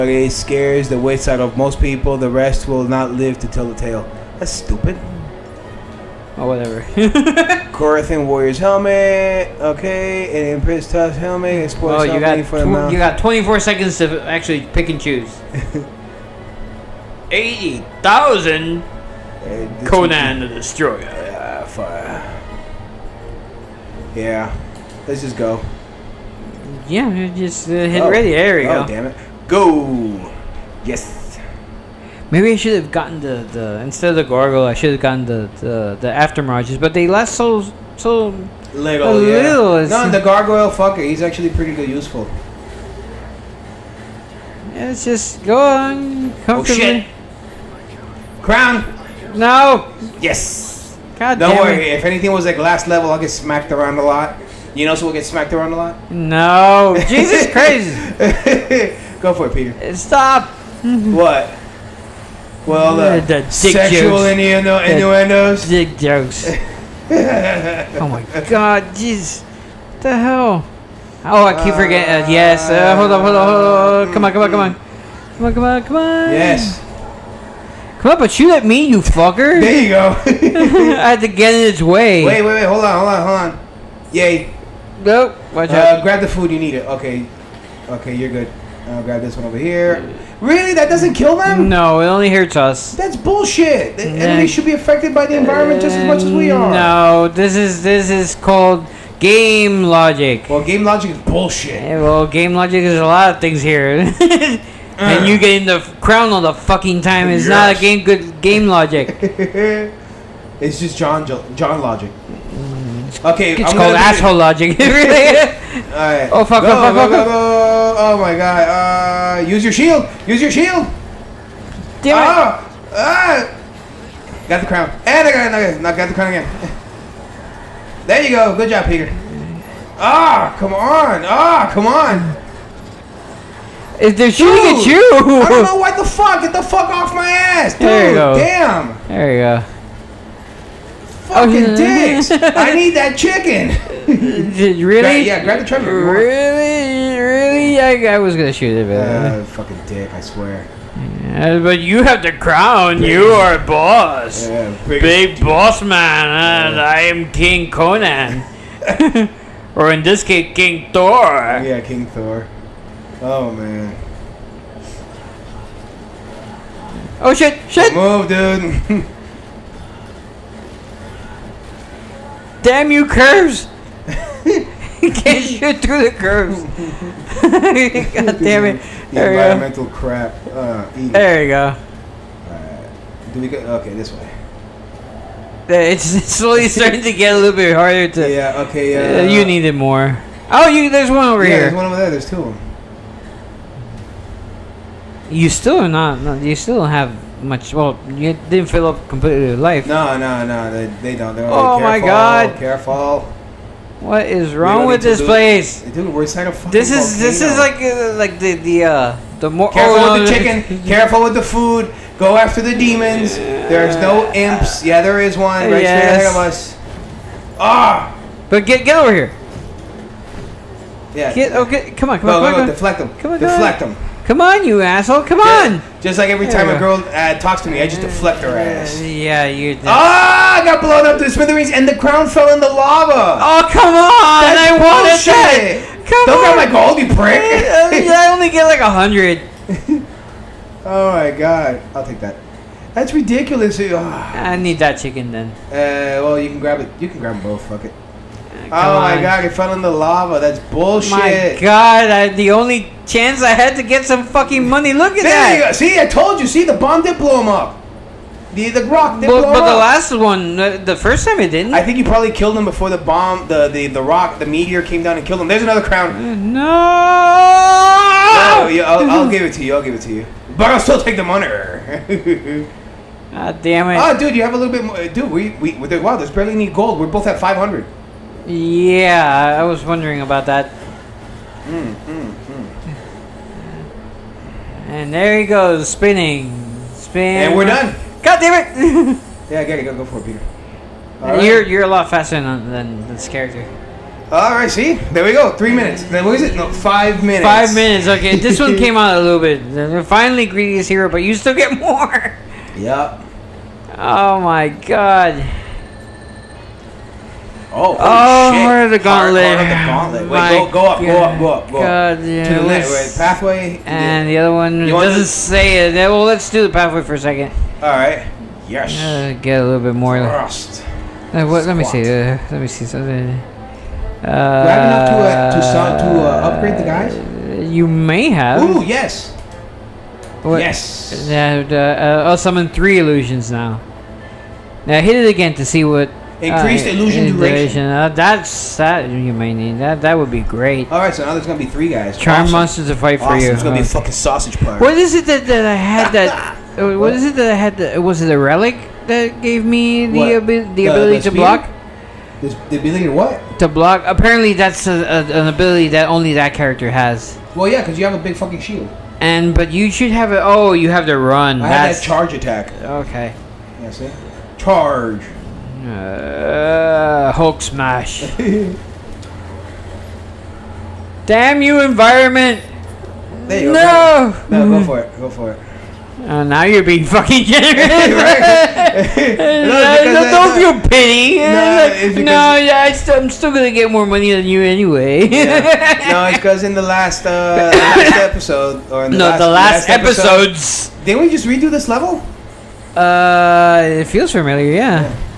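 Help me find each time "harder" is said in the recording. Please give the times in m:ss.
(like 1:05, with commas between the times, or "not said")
3:07.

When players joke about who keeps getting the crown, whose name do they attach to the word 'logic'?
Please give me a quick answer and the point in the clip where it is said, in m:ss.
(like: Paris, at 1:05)
John logic, at 1:51.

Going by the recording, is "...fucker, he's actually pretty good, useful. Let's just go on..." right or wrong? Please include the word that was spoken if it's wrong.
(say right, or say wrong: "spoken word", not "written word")
right.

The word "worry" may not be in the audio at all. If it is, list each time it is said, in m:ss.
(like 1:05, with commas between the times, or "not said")
0:51.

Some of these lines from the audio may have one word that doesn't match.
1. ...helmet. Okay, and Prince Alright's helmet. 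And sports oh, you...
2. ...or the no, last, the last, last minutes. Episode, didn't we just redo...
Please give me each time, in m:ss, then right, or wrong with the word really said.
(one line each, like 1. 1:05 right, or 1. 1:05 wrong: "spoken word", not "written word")
1. 0:08 wrong: "Tough", not "Alright"
2. 6:28 wrong: "episodes", not "minutes".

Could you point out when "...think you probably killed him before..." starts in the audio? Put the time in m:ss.
4:21.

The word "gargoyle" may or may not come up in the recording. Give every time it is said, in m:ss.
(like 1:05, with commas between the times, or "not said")
0:34, 0:40.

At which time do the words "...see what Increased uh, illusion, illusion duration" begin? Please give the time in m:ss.
5:35.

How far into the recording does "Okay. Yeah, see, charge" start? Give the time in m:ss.
6:02.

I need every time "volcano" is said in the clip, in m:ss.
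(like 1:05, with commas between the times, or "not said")
3:27.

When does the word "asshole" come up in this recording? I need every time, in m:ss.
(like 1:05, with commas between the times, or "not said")
1:53, 3:44.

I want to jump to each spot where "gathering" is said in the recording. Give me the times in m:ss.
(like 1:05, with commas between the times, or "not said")
not said.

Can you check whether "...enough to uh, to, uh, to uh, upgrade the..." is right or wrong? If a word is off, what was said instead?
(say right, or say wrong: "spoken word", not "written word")
right.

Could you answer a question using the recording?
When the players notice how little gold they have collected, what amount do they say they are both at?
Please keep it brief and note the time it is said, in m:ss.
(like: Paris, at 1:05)
500, at 4:37.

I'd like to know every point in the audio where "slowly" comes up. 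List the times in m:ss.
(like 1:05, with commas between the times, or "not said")
3:06.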